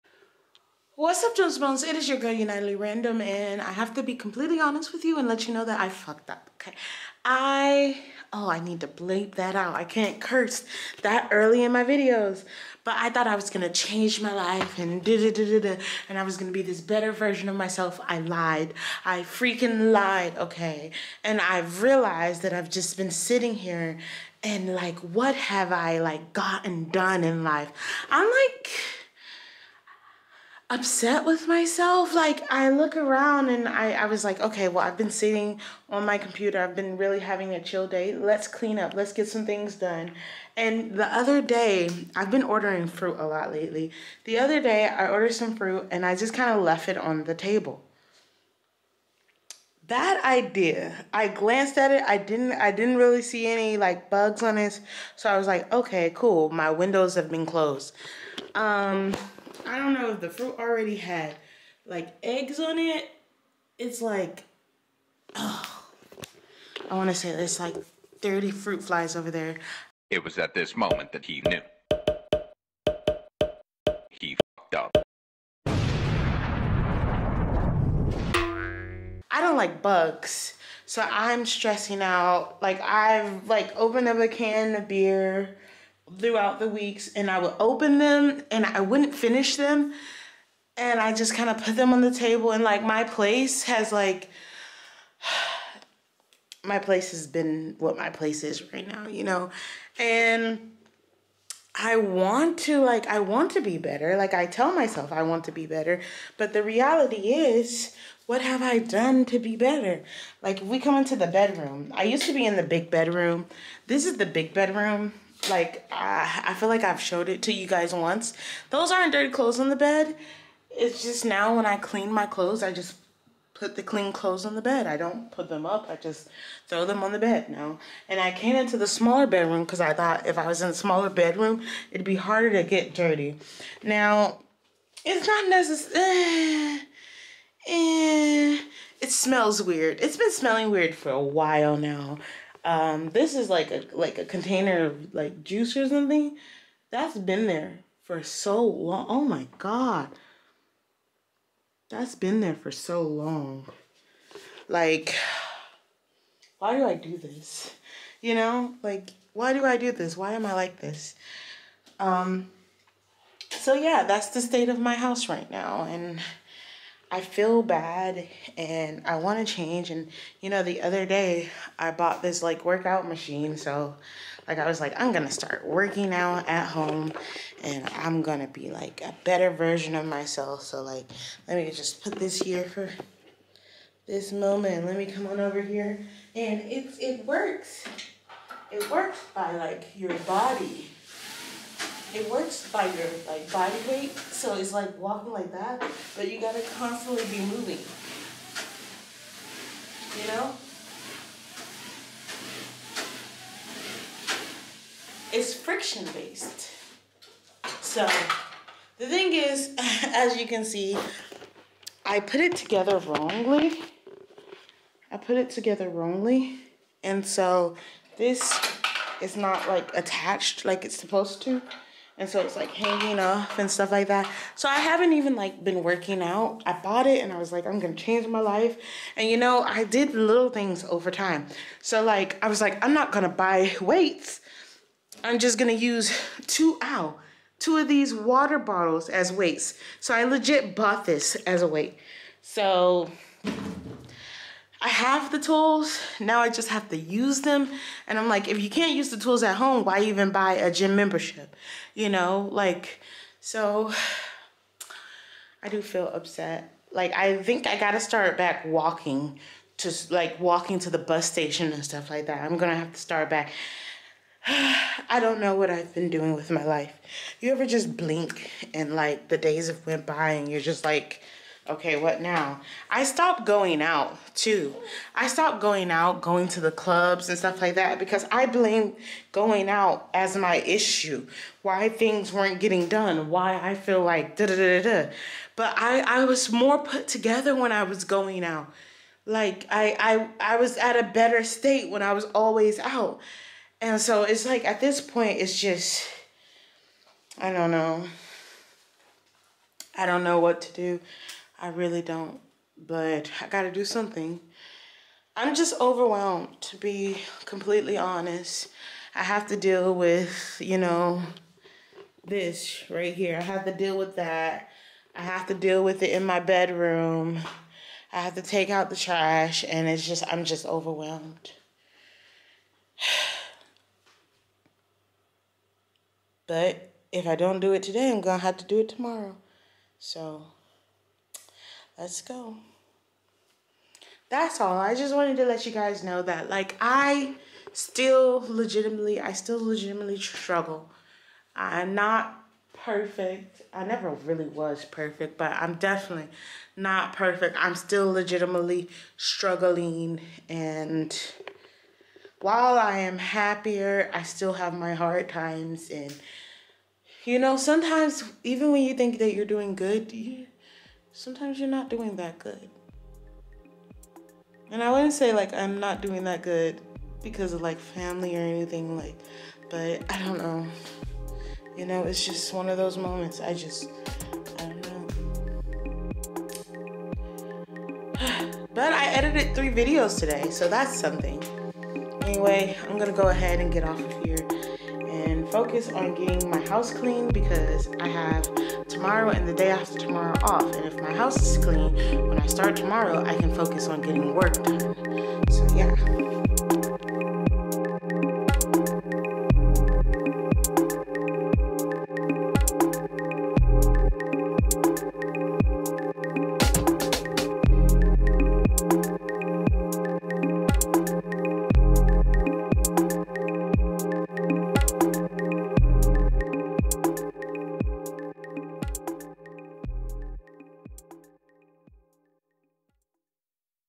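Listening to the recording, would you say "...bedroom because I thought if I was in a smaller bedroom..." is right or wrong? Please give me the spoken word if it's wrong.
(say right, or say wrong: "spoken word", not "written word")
right.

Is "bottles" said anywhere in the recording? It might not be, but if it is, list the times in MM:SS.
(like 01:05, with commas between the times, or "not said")
03:58.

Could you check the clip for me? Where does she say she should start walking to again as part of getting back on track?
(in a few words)
the bus station.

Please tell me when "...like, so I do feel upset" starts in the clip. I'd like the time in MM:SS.
04:12.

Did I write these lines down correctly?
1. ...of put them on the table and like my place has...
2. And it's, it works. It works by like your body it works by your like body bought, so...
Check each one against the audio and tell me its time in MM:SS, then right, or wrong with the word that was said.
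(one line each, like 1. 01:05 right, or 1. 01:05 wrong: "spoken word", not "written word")
1. 01:31 right
2. 03:06 wrong: "weight", not "bought".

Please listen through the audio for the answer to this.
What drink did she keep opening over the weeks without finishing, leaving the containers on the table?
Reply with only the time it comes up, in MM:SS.
01:24.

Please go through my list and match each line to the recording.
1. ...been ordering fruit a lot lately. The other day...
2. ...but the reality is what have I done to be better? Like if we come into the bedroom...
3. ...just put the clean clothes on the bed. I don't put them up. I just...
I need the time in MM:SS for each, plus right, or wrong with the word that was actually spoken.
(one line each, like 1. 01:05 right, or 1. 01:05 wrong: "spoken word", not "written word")
1. 00:42 right
2. 01:46 right
3. 02:02 right.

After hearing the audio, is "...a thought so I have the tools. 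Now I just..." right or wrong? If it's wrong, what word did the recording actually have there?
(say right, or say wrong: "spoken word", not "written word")
wrong: "weight", not "thought".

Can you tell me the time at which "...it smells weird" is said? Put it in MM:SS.
02:19.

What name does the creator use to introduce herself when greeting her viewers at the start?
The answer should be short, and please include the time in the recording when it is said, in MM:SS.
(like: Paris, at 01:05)
Unitedly Random, at 00:02.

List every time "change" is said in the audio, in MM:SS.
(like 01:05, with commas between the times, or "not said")
00:13, 02:49, 03:47.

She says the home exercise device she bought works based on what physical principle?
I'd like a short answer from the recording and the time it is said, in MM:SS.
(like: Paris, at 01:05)
friction, at 03:25.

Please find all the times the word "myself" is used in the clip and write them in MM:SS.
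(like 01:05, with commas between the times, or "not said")
00:17, 00:31, 01:44, 03:00.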